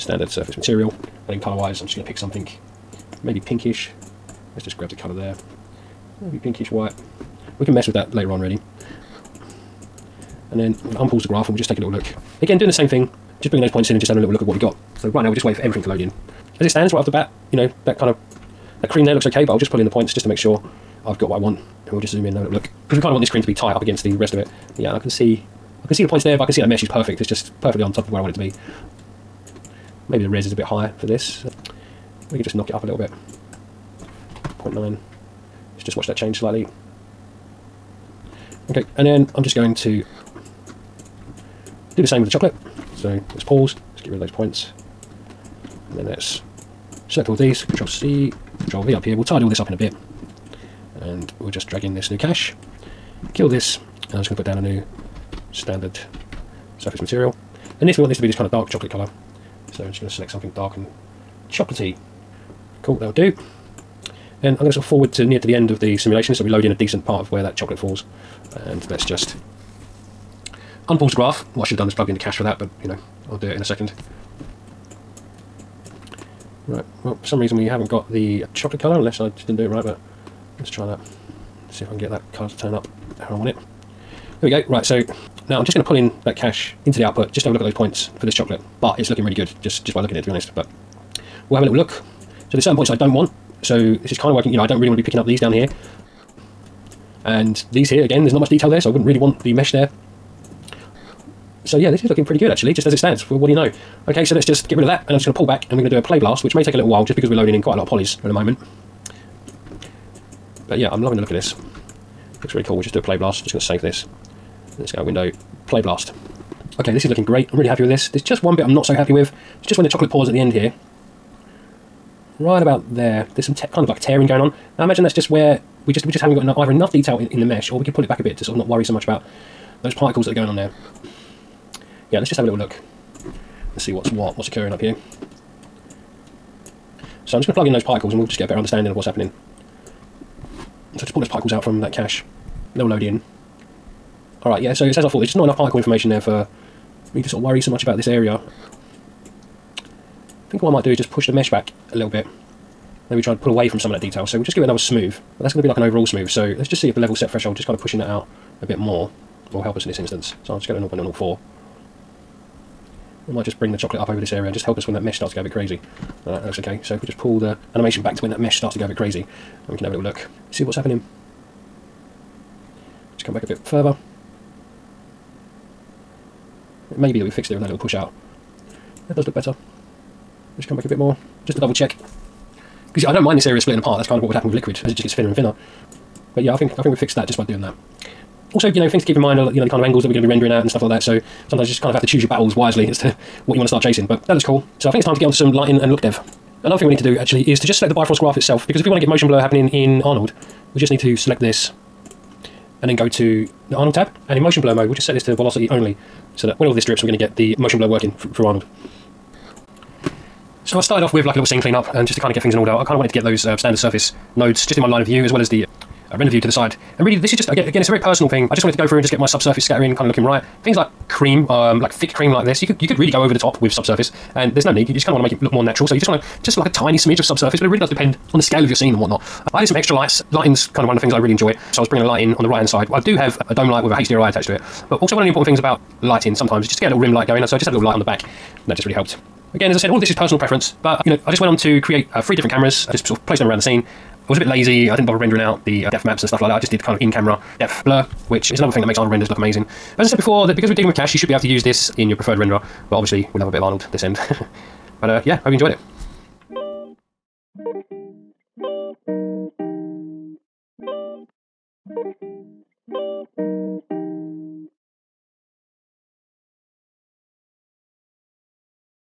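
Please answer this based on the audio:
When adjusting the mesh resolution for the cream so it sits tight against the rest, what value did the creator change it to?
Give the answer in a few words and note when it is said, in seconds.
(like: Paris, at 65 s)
0.9, at 34 s.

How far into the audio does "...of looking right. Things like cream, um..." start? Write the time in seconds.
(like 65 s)
220 s.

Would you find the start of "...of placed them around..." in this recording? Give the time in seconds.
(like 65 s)
243 s.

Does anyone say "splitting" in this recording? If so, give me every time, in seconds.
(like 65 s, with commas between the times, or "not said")
183 s.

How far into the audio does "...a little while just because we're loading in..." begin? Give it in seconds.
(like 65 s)
106 s.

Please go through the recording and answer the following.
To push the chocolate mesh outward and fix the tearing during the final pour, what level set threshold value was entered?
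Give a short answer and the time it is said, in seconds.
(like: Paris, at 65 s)
0.004, at 160 s.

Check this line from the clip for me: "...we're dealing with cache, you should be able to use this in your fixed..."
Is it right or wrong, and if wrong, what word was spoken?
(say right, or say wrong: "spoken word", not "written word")
wrong: "preferred", not "fixed".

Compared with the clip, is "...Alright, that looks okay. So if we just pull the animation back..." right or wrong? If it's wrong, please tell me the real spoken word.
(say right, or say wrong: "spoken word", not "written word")
right.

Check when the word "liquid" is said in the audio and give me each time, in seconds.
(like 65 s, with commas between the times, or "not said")
184 s.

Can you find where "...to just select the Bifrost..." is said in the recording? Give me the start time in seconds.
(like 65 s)
197 s.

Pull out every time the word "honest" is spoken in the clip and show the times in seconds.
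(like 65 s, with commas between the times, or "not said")
90 s.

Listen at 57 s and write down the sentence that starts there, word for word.
And this, we want this to be this kind of dark chocolate colour.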